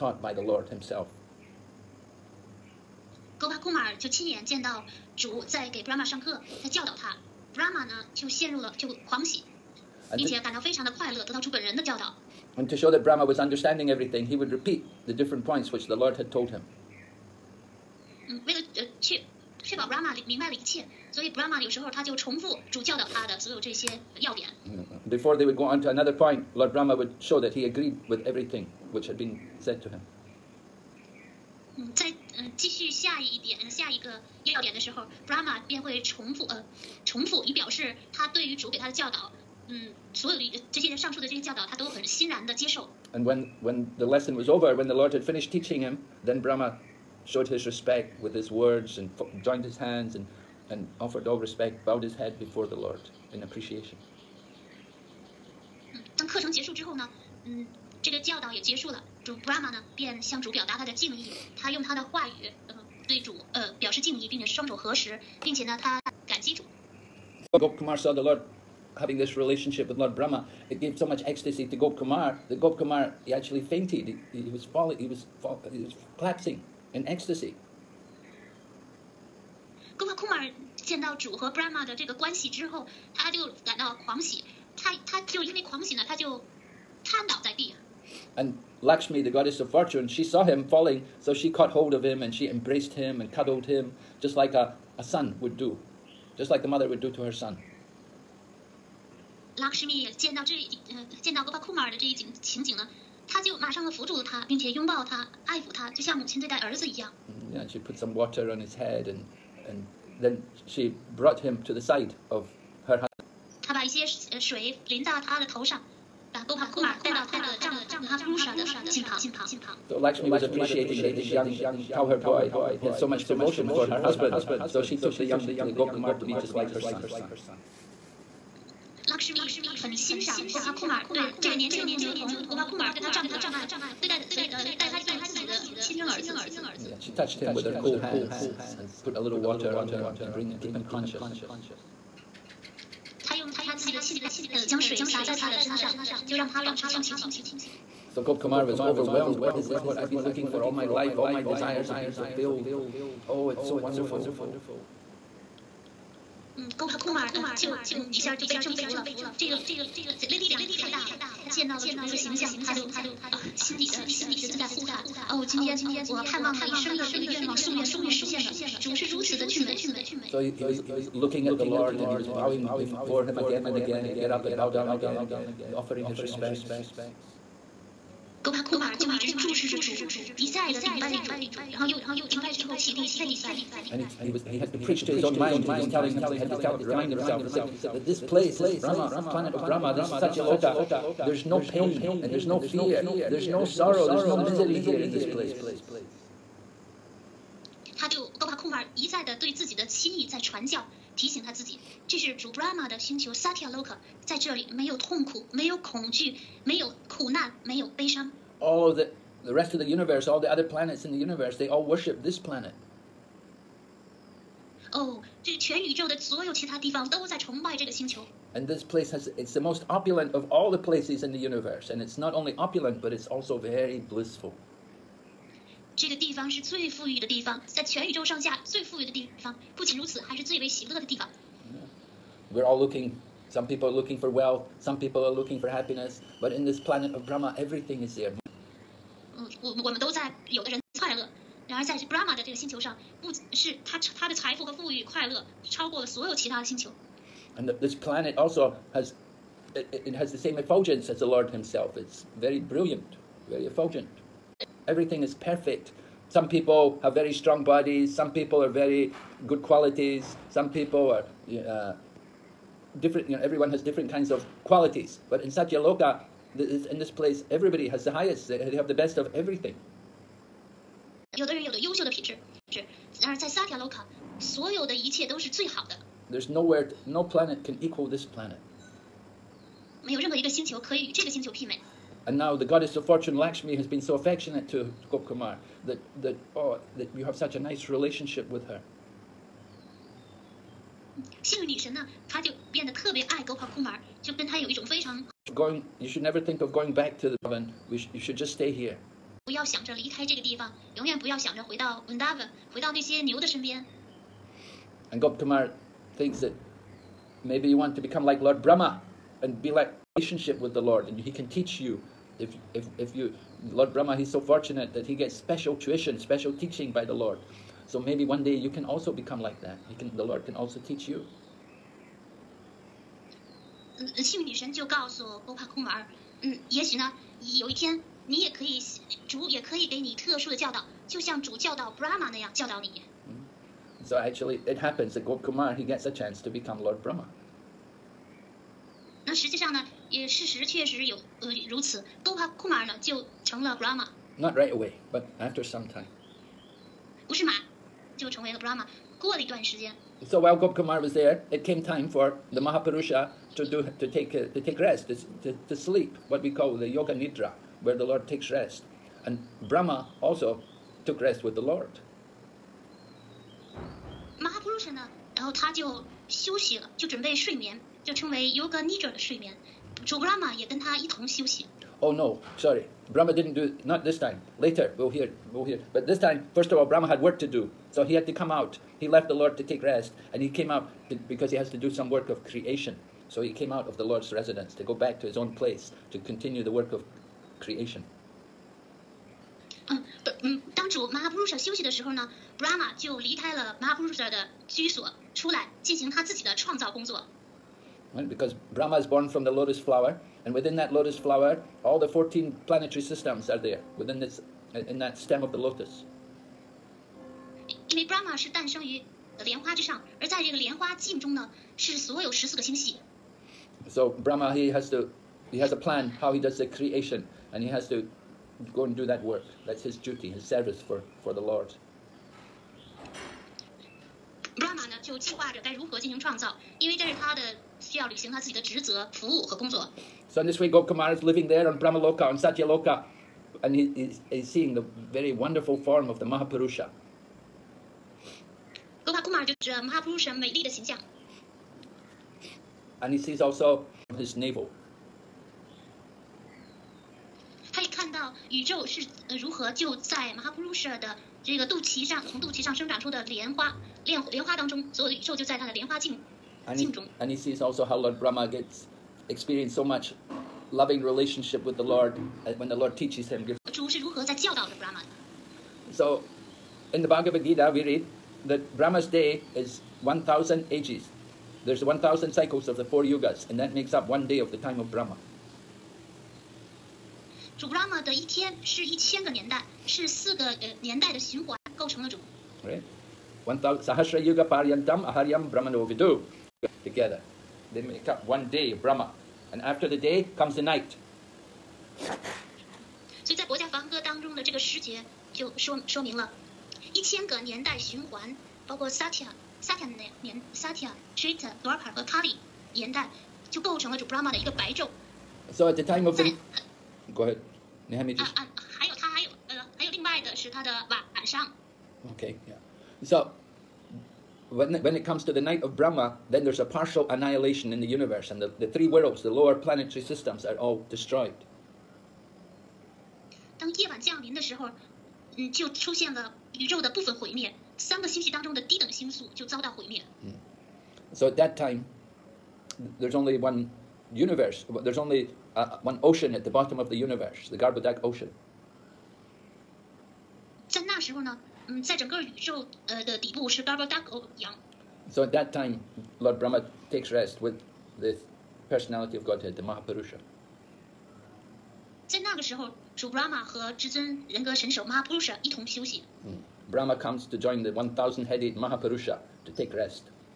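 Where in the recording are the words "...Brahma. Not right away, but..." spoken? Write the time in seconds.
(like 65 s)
343 s.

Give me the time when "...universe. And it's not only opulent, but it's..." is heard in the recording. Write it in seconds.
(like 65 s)
221 s.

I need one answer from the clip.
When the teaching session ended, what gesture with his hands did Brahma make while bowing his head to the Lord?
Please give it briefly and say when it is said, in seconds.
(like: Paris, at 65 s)
Joined his hands, at 49 s.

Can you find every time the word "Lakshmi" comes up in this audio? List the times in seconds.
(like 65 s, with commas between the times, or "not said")
119 s, 283 s.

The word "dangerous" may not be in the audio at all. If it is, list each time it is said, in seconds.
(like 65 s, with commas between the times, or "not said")
not said.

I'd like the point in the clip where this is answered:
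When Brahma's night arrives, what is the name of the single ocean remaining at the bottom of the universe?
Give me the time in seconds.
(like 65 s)
537 s.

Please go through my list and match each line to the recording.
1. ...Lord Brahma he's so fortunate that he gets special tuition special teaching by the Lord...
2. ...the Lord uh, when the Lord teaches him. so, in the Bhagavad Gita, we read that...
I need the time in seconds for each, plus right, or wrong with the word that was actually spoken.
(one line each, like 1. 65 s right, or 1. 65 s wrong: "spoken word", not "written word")
1. 313 s right
2. 461 s right.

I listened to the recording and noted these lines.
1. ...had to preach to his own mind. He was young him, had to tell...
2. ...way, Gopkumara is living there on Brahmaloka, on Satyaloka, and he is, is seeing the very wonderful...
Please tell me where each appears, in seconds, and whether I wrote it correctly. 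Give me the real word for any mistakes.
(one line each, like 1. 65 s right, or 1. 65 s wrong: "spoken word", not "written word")
1. 184 s wrong: "telling", not "young"
2. 430 s right.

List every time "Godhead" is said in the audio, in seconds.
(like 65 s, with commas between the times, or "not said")
549 s.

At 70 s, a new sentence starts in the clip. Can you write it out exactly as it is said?
It gave so much ecstasy to Gopakumar that Gopakumar he actually fainted.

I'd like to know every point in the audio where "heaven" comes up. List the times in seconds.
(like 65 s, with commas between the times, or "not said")
297 s.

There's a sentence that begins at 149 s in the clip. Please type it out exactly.
This is what I've been looking for all my life.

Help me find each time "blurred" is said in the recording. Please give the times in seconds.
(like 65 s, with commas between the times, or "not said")
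not said.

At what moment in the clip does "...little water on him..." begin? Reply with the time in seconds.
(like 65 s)
139 s.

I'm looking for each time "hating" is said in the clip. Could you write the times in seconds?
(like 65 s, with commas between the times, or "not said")
not said.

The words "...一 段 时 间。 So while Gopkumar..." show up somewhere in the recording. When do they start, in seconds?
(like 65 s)
349 s.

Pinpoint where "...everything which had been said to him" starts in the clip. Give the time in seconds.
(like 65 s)
28 s.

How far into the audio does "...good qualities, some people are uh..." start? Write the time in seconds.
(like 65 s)
259 s.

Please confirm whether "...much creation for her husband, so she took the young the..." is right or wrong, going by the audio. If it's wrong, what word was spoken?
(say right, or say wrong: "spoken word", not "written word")
wrong: "devotion", not "creation".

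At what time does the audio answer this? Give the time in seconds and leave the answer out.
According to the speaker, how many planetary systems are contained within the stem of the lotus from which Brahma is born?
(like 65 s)
402 s.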